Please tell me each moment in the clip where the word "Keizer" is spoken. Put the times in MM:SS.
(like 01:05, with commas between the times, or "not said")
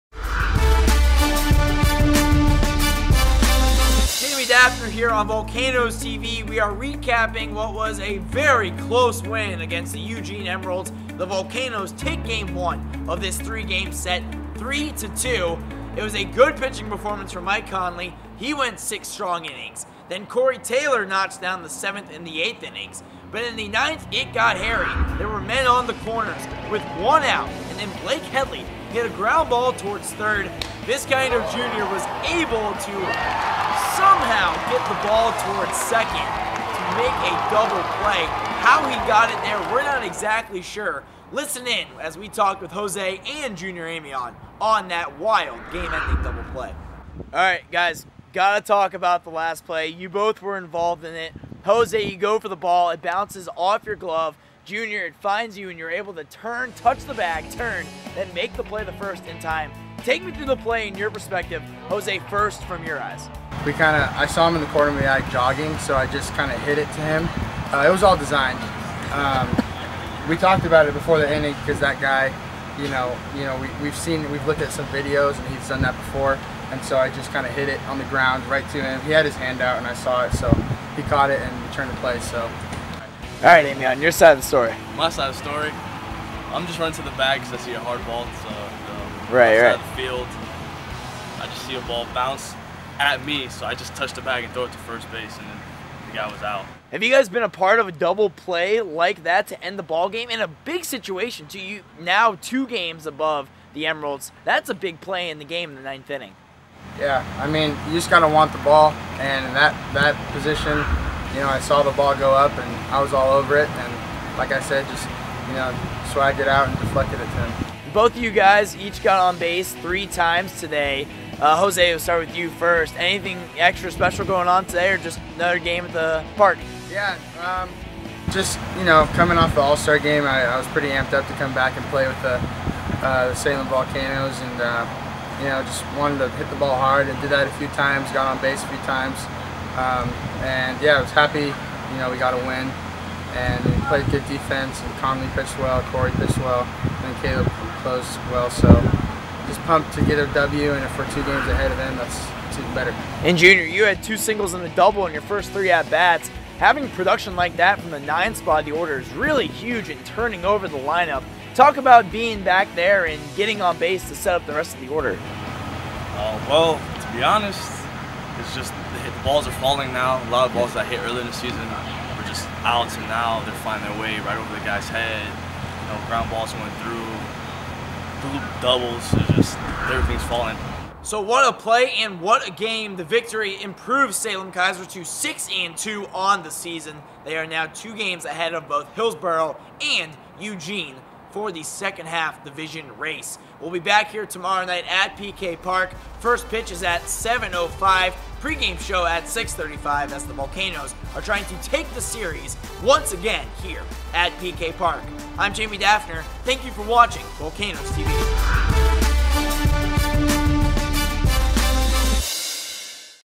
03:04.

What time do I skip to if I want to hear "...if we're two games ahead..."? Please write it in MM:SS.
02:30.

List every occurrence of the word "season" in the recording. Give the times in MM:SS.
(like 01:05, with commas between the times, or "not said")
02:51, 03:06.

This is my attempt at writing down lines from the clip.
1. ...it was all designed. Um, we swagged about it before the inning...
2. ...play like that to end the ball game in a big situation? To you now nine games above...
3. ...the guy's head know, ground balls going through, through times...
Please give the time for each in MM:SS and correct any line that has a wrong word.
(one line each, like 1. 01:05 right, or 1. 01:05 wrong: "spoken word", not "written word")
1. 01:07 wrong: "talked", not "swagged"
2. 01:38 wrong: "two", not "nine"
3. 02:54 wrong: "doubles", not "times".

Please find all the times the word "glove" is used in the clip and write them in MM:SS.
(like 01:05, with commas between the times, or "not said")
00:53.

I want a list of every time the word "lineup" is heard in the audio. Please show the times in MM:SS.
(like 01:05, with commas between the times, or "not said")
02:40.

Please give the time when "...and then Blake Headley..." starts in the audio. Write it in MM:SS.
00:27.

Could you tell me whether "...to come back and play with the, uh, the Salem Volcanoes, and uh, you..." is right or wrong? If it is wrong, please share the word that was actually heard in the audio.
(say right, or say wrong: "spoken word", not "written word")
right.